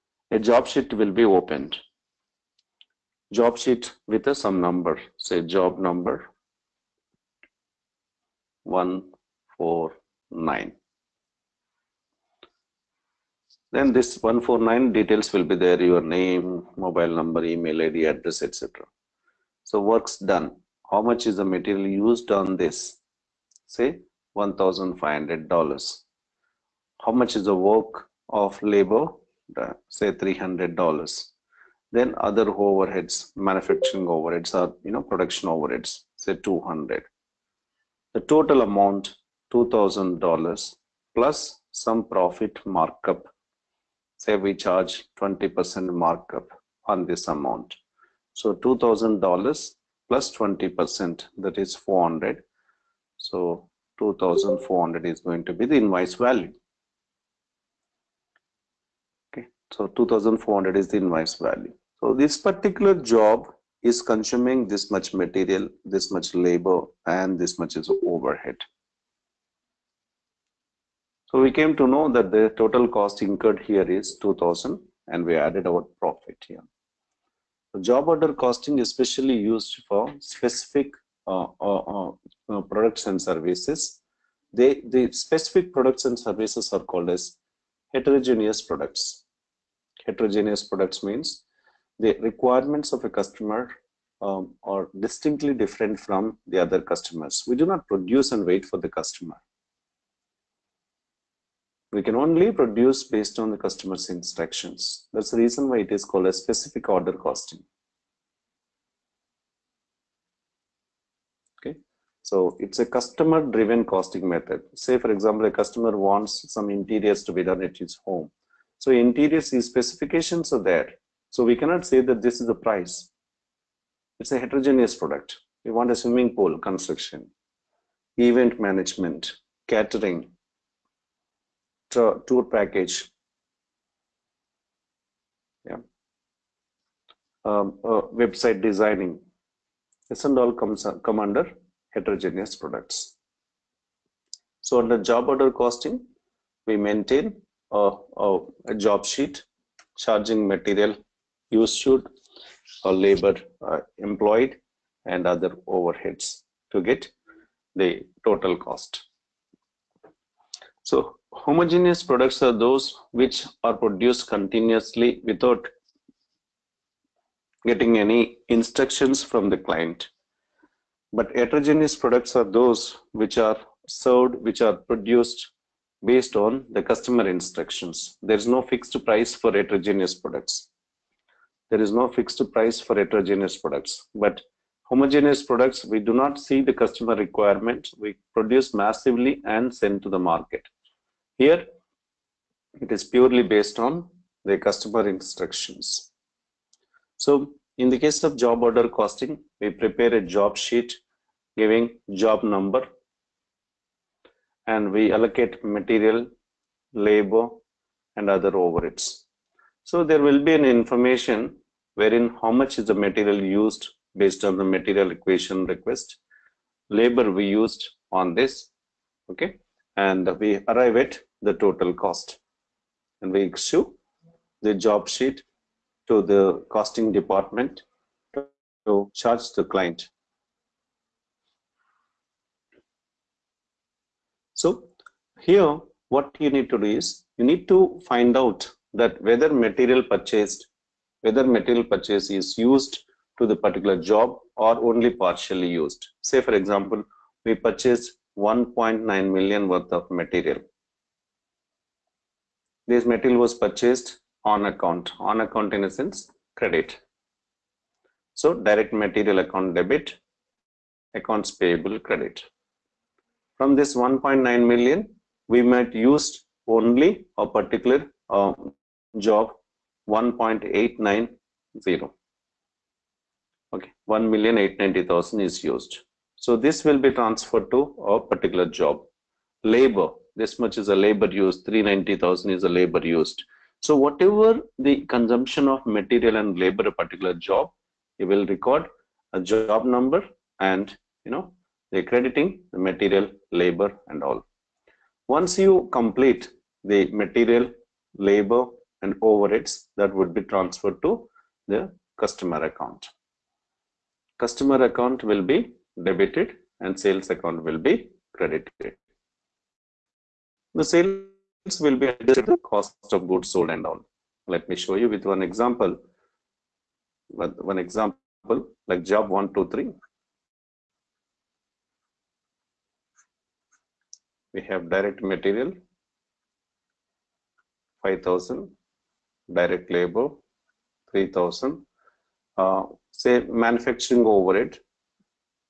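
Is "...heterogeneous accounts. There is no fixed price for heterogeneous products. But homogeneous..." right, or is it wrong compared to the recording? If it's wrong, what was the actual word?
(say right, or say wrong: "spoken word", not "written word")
wrong: "products", not "accounts".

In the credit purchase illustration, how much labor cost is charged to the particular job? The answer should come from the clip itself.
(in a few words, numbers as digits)
390,000.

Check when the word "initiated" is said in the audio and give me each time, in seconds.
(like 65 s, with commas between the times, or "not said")
not said.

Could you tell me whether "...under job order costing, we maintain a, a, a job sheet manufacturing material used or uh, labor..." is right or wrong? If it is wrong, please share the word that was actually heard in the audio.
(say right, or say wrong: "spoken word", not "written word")
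wrong: "charging", not "manufacturing".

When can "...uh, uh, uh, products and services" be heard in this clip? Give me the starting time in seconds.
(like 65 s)
81 s.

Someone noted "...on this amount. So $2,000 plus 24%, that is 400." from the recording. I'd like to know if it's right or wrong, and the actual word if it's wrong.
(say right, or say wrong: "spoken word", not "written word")
wrong: "20", not "24".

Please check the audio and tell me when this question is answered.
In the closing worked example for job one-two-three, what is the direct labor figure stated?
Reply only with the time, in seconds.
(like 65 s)
331 s.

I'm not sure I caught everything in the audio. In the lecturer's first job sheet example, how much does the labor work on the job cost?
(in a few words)
$300.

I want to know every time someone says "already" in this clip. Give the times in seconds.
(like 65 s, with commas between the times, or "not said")
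not said.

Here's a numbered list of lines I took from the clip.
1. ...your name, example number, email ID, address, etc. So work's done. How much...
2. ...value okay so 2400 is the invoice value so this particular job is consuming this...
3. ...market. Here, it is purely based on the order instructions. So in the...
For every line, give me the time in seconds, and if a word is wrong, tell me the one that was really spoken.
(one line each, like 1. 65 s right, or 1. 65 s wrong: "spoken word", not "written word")
1. 15 s wrong: "mobile", not "example"
2. 56 s right
3. 190 s wrong: "customer", not "order".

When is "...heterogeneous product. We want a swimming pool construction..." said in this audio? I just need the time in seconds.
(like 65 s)
124 s.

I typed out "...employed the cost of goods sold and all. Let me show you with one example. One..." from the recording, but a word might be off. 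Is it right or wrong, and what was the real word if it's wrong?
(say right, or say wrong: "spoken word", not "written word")
wrong: "adjusted", not "employed".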